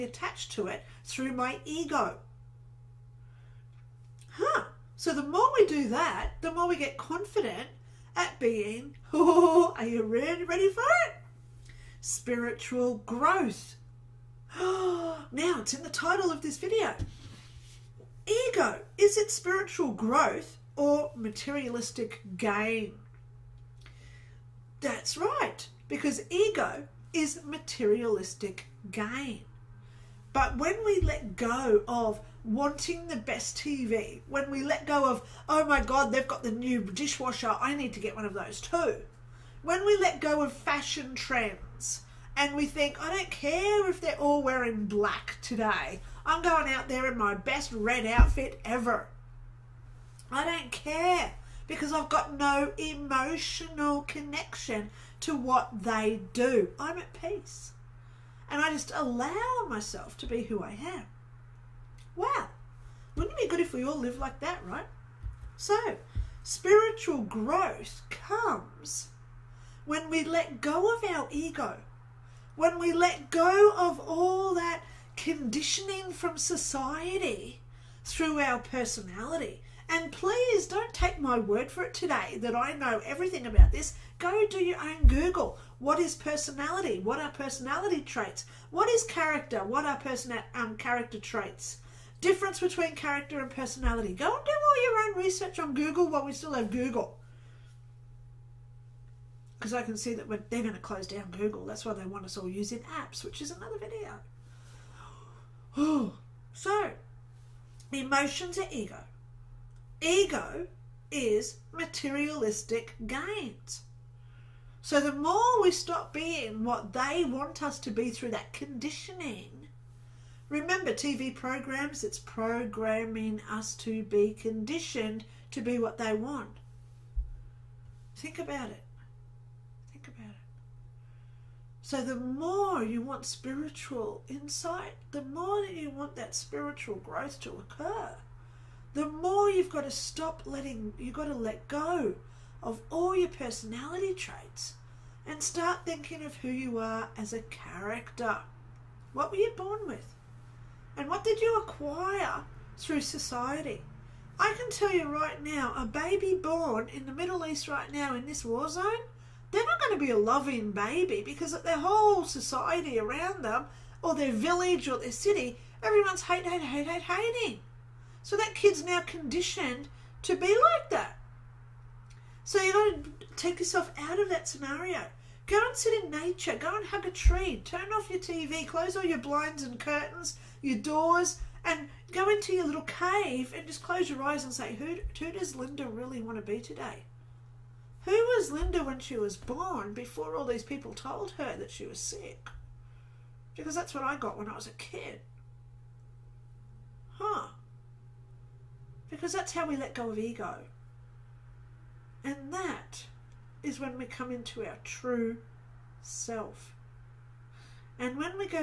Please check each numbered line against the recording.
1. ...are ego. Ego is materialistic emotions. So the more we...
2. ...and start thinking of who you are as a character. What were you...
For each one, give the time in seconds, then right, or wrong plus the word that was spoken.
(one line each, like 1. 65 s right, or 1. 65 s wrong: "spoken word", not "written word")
1. 108 s wrong: "gains", not "emotions"
2. 145 s right.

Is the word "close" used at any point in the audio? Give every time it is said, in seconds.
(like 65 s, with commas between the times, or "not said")
100 s, 178 s, 183 s.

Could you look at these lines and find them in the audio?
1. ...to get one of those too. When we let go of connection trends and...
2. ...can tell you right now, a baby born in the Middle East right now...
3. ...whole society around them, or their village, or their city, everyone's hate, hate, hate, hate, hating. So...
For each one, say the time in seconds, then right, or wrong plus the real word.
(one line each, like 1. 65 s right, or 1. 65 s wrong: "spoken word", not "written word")
1. 37 s wrong: "fashion", not "connection"
2. 154 s right
3. 161 s right.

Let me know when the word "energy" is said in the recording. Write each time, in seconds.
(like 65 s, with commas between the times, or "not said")
not said.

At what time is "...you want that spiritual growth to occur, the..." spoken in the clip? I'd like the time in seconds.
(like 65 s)
135 s.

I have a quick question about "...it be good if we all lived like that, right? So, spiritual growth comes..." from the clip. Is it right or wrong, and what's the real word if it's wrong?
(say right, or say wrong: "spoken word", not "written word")
right.